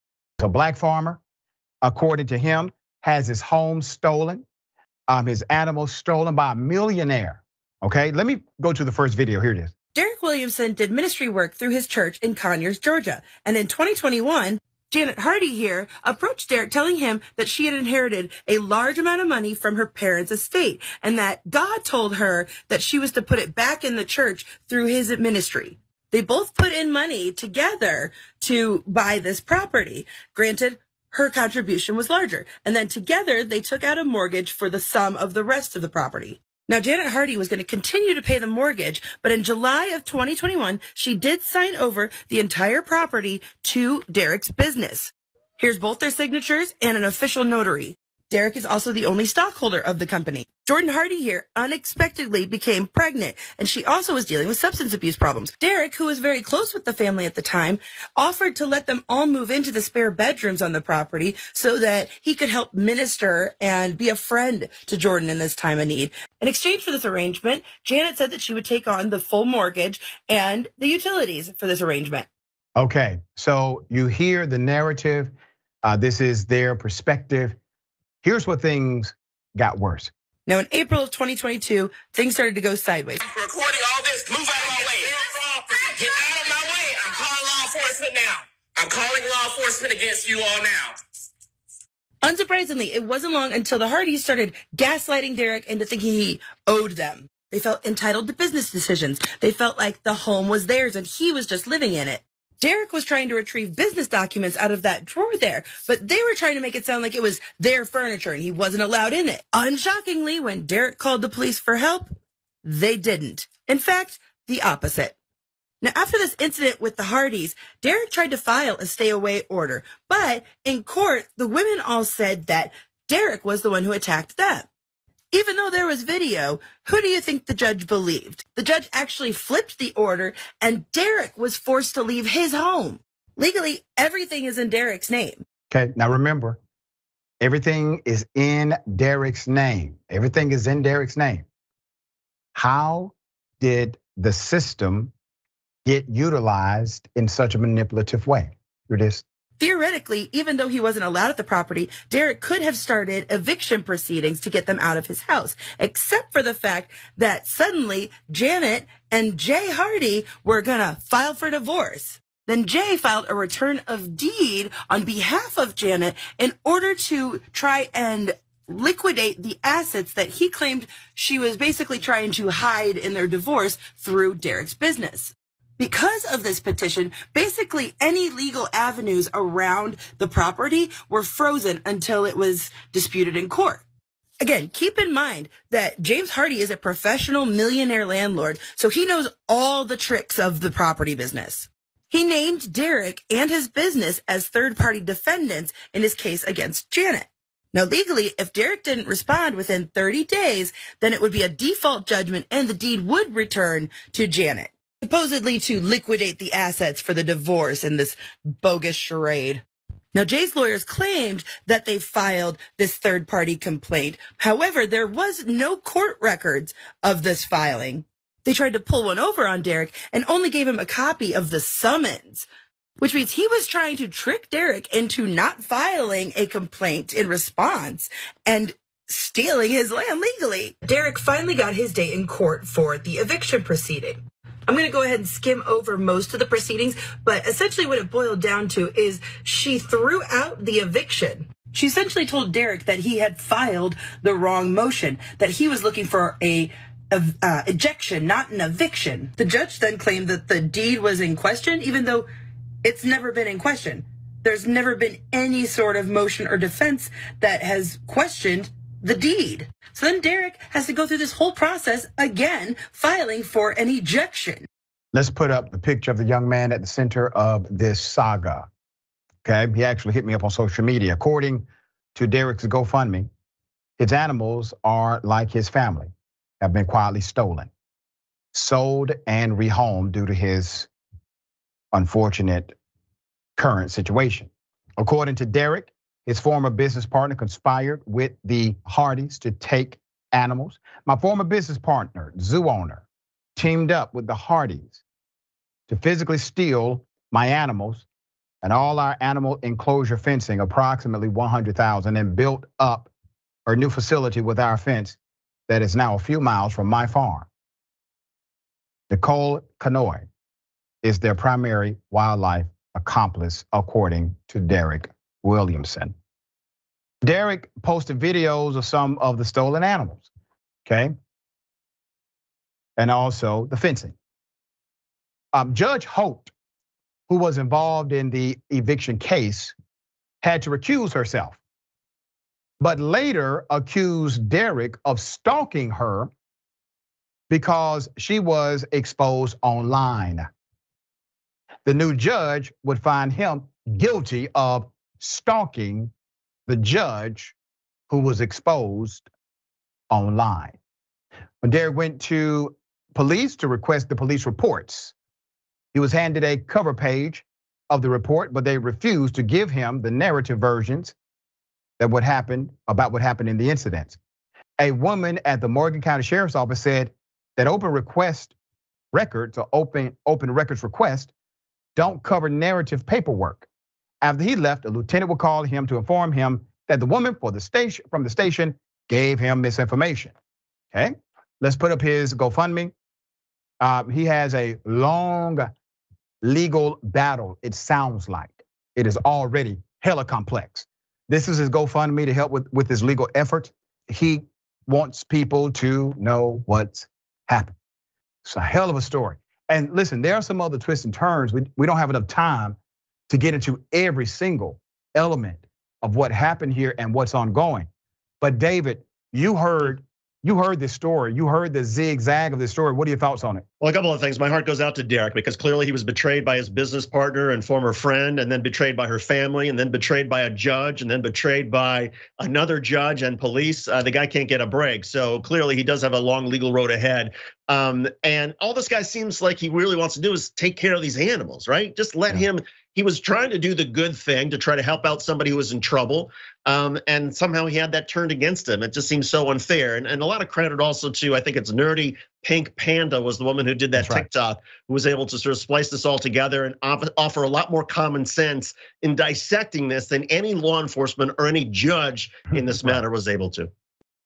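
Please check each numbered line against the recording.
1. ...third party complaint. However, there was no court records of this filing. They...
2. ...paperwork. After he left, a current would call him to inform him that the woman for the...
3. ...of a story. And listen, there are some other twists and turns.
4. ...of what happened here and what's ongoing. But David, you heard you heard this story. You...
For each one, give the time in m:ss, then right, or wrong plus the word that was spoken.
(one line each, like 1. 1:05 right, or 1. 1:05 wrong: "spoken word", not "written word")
1. 3:32 right
2. 6:13 wrong: "lieutenant", not "current"
3. 6:38 right
4. 6:46 right.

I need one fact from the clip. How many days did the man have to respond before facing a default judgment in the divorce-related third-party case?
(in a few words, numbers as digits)
30 days.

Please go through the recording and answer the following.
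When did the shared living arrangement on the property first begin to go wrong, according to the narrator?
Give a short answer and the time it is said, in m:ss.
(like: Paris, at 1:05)
April 2022, at 1:20.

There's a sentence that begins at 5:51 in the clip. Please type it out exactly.
Madera went to police to request the police reports.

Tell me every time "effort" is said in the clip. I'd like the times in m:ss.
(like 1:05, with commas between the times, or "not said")
6:33.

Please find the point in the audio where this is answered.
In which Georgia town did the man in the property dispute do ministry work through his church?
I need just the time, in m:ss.
0:12.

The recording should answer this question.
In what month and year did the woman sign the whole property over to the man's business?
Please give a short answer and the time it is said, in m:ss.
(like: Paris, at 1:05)
July 2021, at 0:39.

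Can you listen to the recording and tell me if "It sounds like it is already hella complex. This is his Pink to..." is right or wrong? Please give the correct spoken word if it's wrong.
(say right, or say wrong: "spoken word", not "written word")
wrong: "GoFundMe", not "Pink".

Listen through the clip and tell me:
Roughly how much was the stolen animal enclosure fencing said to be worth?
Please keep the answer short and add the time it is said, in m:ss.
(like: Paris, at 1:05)
100,000, at 5:00.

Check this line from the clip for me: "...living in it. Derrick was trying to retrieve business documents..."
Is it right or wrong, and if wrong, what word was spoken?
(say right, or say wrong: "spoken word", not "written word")
right.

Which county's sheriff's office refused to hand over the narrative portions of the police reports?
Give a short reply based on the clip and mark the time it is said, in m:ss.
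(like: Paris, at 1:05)
Morgan County, at 6:05.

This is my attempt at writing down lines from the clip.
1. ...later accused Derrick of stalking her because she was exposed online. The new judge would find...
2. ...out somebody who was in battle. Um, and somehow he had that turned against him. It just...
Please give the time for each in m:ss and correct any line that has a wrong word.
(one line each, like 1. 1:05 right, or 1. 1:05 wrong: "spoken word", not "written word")
1. 5:32 right
2. 7:15 wrong: "trouble", not "battle".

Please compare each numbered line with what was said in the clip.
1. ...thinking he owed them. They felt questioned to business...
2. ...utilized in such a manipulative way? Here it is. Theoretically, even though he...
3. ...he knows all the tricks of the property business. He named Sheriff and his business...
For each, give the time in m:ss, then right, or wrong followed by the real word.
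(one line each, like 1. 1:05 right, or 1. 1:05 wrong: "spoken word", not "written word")
1. 1:35 wrong: "entitled", not "questioned"
2. 2:26 right
3. 3:08 wrong: "Derrick", not "Sheriff".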